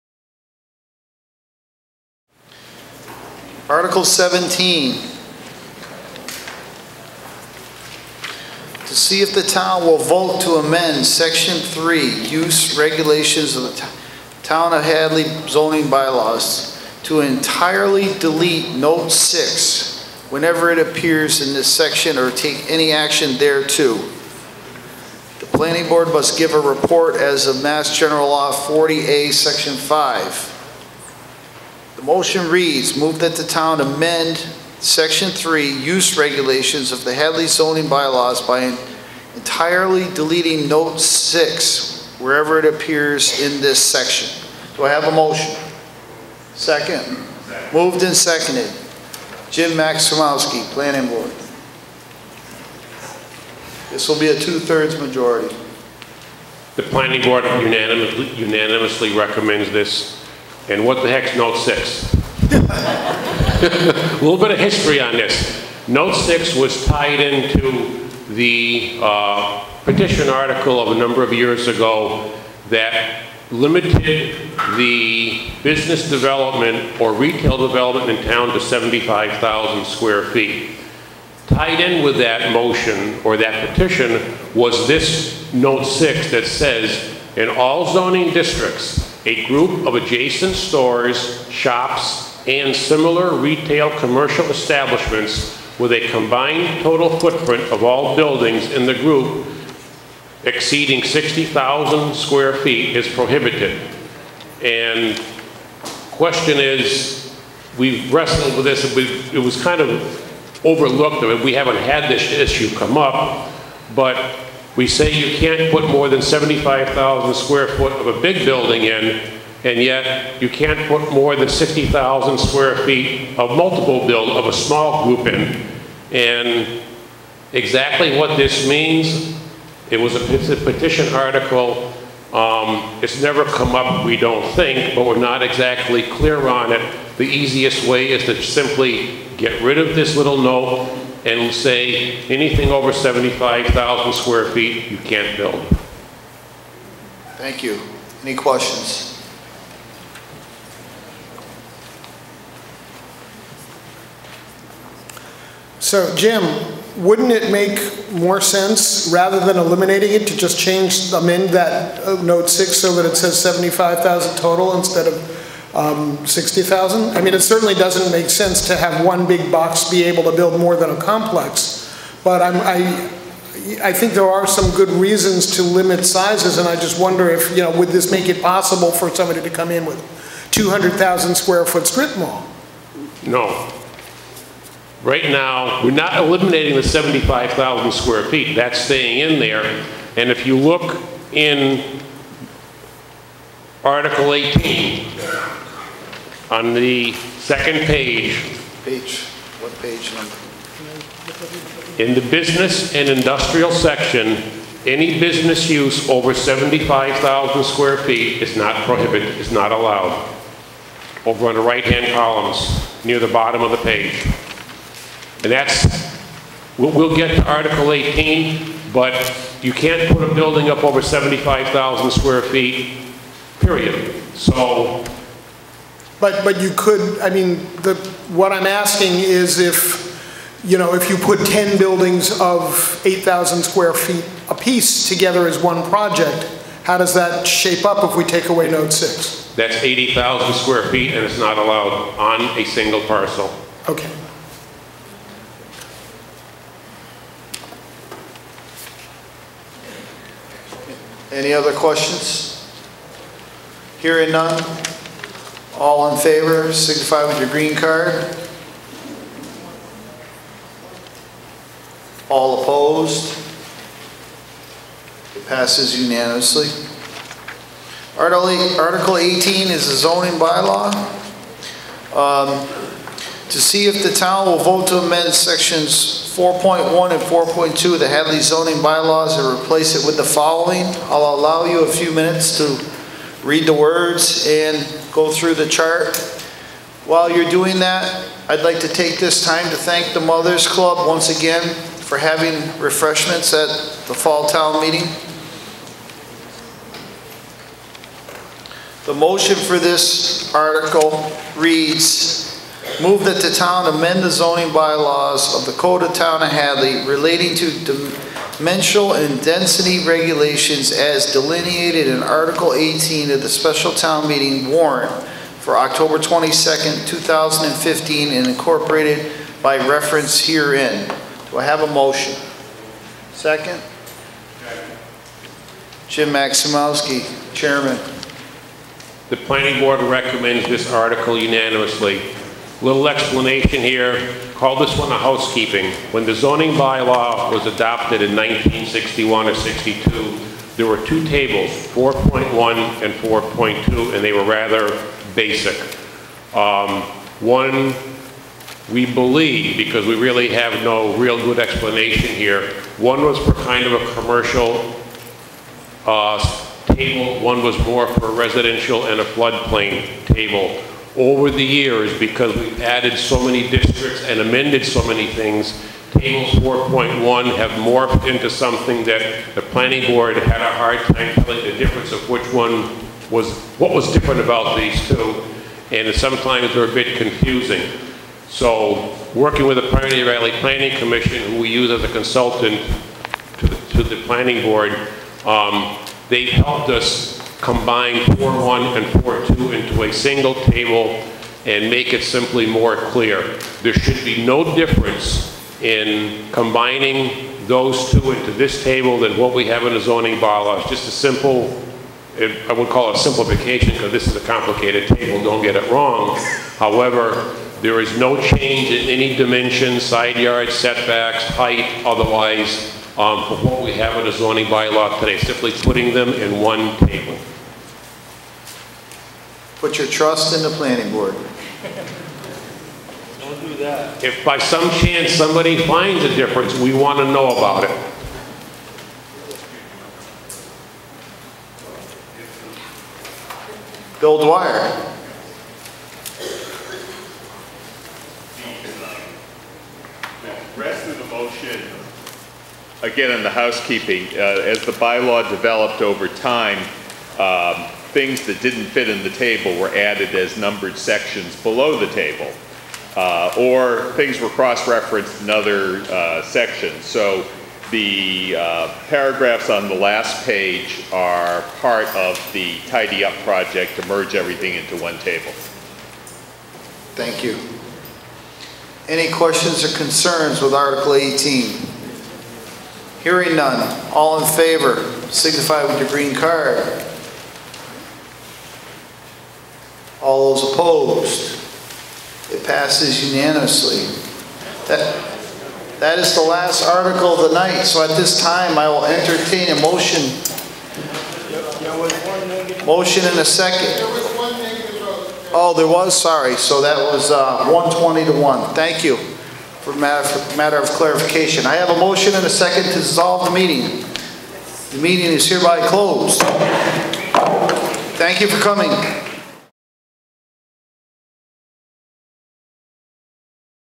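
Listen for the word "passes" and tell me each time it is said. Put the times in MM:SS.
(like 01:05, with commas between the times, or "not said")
04:25, 08:02.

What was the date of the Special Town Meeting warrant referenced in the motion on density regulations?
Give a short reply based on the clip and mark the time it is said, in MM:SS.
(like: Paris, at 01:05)
October 22nd, 2015, at 05:15.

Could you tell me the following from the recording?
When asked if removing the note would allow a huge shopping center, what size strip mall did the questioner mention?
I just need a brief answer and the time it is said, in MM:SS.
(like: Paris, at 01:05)
200,000 square foot, at 03:00.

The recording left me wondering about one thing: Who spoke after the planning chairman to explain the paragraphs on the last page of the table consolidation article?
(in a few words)
Bill Dwyer.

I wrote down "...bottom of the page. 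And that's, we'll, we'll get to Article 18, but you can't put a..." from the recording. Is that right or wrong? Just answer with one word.
right.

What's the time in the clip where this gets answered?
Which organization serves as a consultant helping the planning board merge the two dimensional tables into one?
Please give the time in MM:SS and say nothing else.
06:19.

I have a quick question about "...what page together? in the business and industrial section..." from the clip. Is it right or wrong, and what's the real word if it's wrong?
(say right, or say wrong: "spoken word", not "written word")
wrong: "number", not "together".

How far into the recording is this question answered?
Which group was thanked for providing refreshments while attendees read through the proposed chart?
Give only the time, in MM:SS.
04:50.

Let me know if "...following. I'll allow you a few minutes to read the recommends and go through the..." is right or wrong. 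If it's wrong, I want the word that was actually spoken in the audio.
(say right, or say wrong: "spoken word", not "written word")
wrong: "words", not "recommends".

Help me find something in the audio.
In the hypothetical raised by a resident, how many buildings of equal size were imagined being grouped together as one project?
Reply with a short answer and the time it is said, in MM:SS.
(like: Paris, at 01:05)
10, at 03:51.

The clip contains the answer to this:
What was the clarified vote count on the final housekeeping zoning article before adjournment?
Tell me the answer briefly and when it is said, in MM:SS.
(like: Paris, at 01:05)
120 to 1, at 08:17.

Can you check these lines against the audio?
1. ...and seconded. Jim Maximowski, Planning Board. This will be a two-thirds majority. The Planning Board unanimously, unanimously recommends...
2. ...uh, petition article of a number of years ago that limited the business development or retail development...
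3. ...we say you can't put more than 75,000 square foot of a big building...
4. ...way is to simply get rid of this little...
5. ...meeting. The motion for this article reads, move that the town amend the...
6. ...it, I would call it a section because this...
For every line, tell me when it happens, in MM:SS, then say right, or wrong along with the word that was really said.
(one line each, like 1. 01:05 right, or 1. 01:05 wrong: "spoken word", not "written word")
1. 00:48 right
2. 01:09 right
3. 01:54 right
4. 02:17 right
5. 04:54 right
6. 06:42 wrong: "simplification", not "section".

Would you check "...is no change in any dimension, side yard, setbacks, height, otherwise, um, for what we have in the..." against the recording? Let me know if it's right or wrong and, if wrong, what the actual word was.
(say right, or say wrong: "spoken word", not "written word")
right.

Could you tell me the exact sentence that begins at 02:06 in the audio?
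And exactly what this means, it was a, petition article.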